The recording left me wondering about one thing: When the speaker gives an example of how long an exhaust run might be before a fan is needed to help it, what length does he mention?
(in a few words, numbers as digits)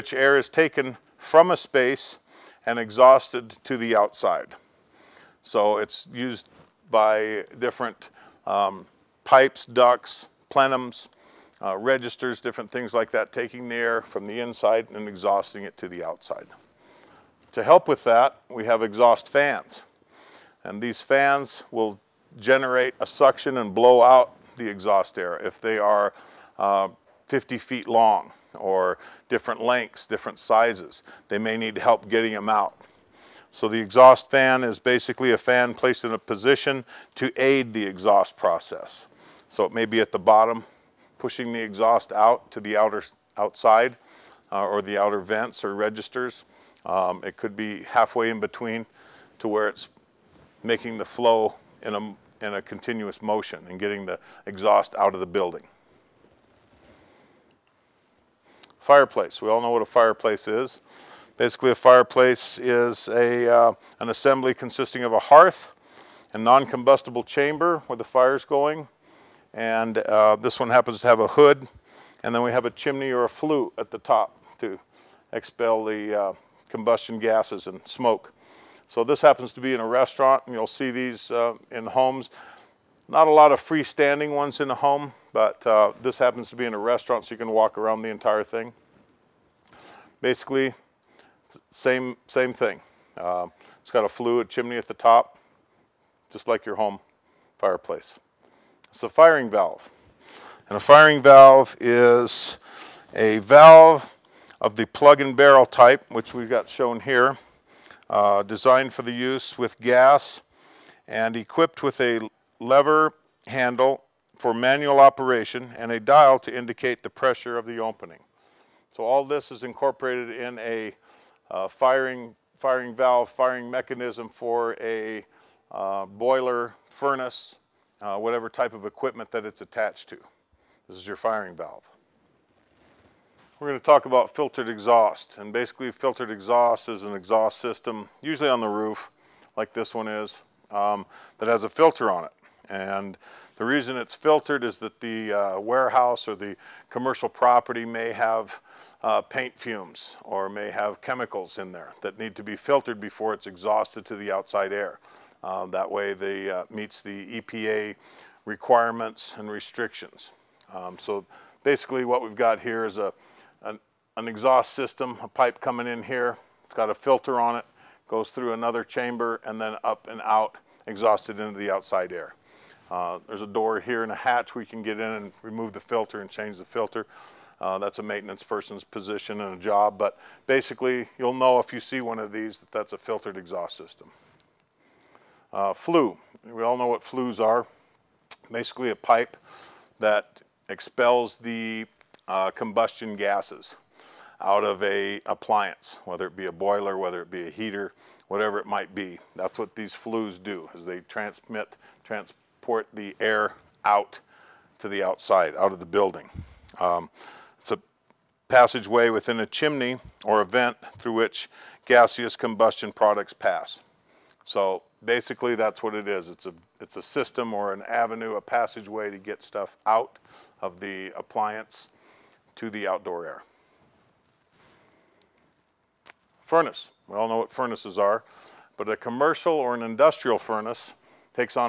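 50 feet.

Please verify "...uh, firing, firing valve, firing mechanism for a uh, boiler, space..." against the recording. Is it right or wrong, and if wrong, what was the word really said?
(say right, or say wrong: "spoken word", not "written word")
wrong: "furnace", not "space".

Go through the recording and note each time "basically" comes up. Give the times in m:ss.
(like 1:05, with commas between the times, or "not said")
0:34, 1:01, 1:30, 2:15, 2:41, 3:00, 3:08, 3:35.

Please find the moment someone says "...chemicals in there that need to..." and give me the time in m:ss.
2:31.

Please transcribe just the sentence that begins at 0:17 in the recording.
To help with that, we have exhaust fans.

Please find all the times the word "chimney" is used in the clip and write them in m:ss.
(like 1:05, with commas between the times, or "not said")
1:12, 1:34, 3:29.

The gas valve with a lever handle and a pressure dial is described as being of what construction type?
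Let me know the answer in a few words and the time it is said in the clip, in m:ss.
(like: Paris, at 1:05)
plug and barrel, at 1:44.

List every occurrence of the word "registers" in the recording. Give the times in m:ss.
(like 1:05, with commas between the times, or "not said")
0:11, 0:45.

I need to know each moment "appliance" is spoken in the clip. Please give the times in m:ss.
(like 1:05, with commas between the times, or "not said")
3:15, 3:41.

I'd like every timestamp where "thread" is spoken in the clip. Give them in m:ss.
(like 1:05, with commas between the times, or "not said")
not said.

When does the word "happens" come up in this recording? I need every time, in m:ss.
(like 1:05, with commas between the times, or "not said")
1:10, 1:19, 1:26.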